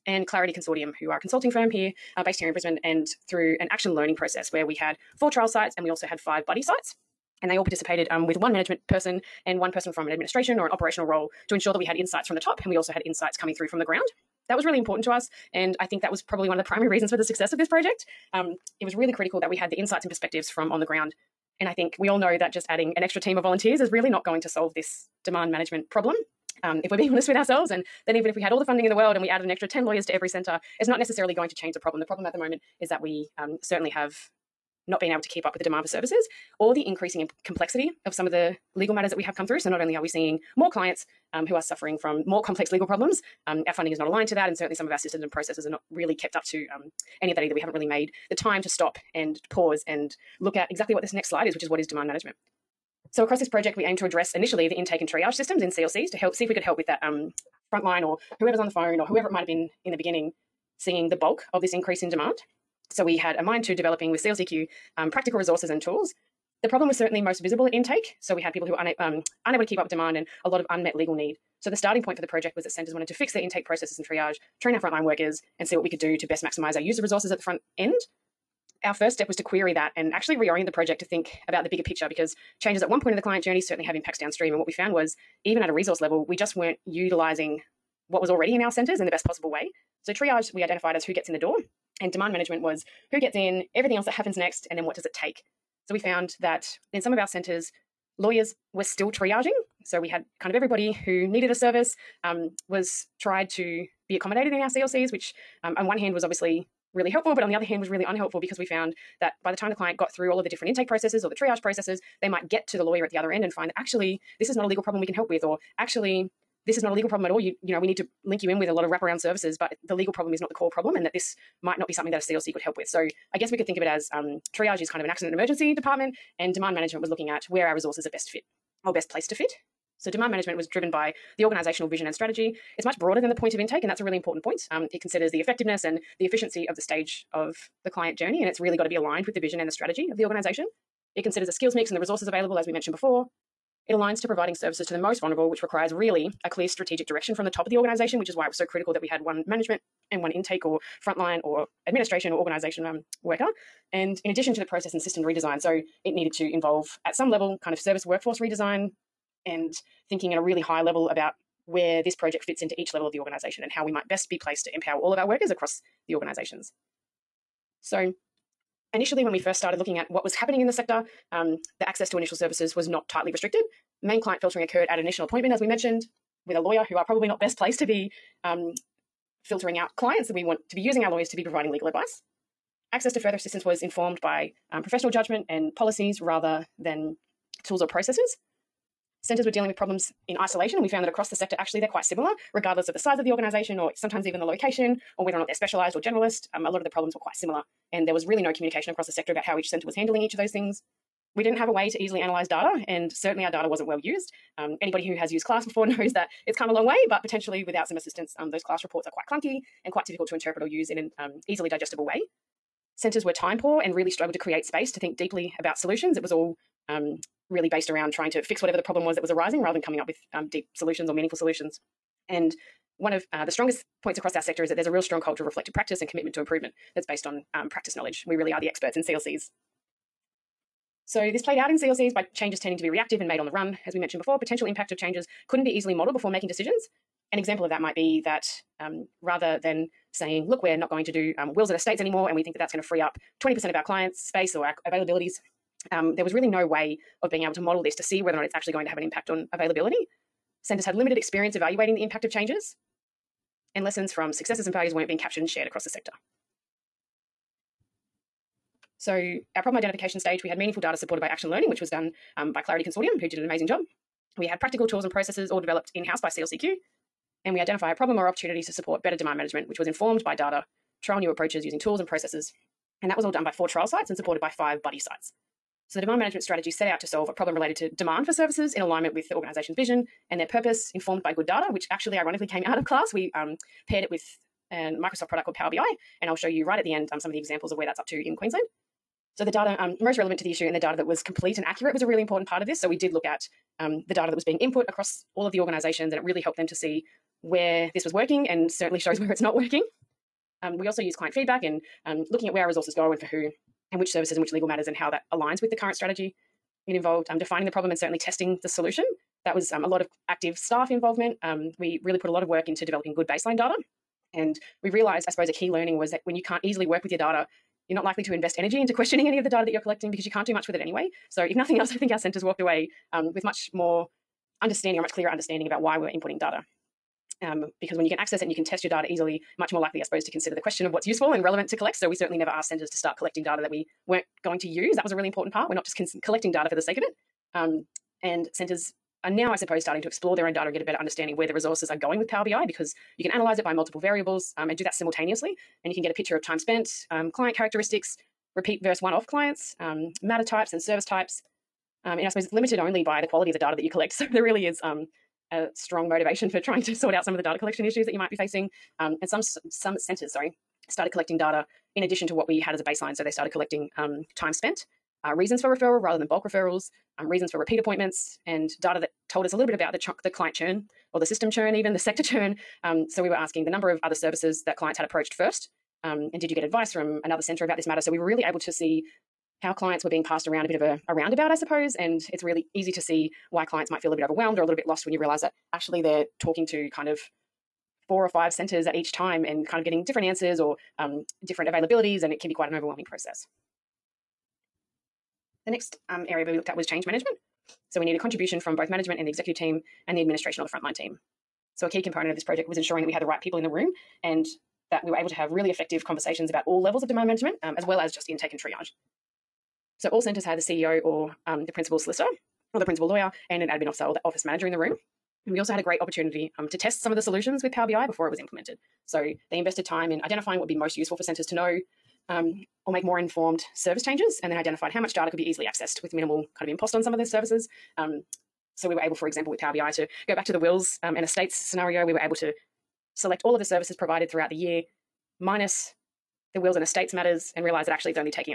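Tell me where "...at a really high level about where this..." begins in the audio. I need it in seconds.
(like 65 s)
160 s.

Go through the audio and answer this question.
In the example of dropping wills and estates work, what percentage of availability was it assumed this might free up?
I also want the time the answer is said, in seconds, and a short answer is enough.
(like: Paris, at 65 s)
20%, at 243 s.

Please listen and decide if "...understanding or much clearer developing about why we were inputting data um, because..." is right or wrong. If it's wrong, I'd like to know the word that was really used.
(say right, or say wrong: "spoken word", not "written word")
wrong: "understanding", not "developing".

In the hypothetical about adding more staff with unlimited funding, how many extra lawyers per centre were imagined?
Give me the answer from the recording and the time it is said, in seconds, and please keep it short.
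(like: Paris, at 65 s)
10, at 29 s.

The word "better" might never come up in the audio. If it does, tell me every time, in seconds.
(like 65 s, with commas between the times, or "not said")
269 s, 340 s.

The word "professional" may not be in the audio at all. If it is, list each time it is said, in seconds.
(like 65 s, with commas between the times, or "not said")
184 s.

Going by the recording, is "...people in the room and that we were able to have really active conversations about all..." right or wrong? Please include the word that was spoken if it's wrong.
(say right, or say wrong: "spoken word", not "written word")
wrong: "effective", not "active".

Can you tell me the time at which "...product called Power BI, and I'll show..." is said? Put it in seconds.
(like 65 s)
285 s.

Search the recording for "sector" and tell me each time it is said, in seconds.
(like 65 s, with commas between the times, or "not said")
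170 s, 191 s, 199 s, 224 s, 255 s, 371 s.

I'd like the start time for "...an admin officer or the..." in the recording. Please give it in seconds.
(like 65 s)
413 s.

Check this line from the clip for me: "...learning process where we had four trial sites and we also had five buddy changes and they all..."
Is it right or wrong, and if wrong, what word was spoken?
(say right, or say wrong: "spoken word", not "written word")
wrong: "sites", not "changes".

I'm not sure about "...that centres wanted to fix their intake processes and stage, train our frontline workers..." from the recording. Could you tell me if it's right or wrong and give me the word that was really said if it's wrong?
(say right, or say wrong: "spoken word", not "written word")
wrong: "triage", not "stage".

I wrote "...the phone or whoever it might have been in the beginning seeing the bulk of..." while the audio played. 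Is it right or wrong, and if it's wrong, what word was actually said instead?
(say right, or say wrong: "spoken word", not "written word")
right.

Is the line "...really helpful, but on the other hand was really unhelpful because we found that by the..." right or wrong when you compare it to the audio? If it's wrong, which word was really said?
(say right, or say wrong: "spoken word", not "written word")
right.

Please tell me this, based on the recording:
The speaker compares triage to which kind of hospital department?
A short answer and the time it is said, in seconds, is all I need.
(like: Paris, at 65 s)
accident and emergency, at 125 s.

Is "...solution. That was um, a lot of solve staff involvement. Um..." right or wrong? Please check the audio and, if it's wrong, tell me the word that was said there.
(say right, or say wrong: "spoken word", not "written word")
wrong: "active", not "solve".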